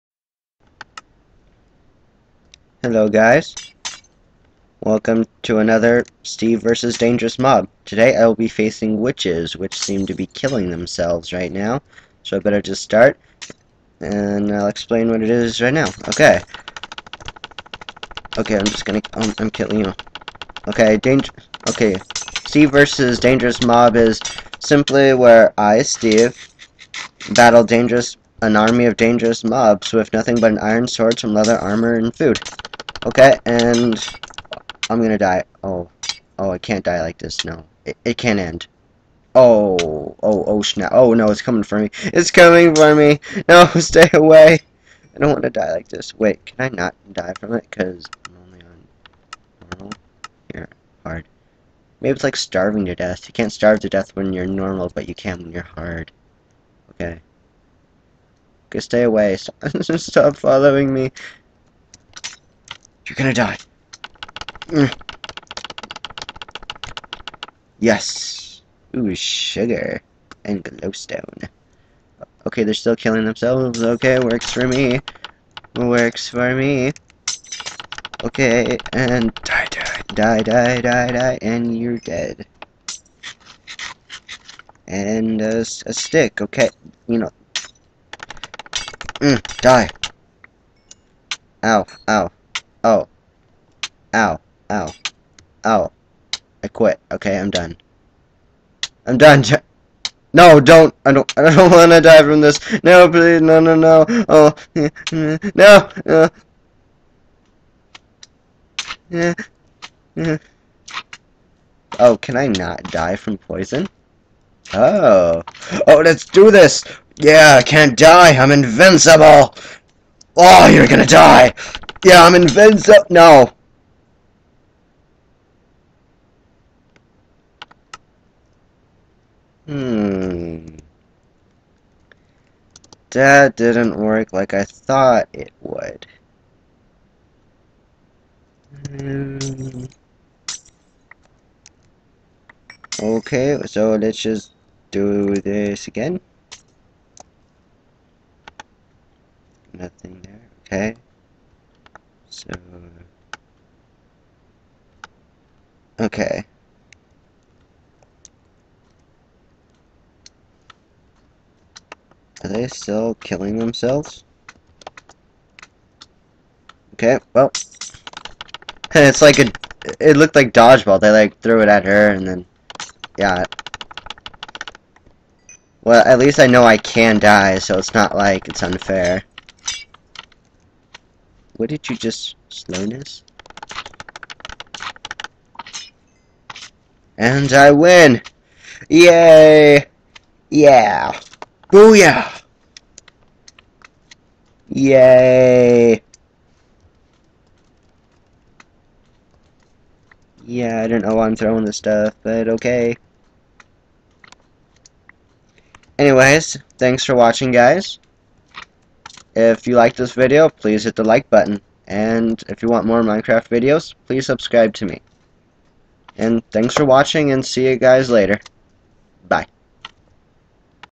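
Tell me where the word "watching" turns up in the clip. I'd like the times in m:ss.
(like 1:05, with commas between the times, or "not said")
3:27, 3:36.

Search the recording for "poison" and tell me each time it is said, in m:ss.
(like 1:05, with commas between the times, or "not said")
1:53.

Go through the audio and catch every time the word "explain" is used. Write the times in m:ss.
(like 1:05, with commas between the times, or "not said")
0:14.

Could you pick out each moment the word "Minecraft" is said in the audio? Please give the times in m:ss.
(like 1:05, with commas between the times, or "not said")
3:33.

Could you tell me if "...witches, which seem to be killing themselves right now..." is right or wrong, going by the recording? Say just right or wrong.
right.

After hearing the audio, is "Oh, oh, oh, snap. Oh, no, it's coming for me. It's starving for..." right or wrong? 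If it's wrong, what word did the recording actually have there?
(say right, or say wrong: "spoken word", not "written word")
wrong: "coming", not "starving".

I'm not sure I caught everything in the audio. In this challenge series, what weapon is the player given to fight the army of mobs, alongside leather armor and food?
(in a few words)
iron sword.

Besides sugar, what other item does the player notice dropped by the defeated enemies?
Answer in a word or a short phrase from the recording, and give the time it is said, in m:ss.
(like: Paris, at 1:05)
glowstone, at 1:10.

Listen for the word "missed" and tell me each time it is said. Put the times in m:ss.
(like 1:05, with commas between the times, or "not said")
not said.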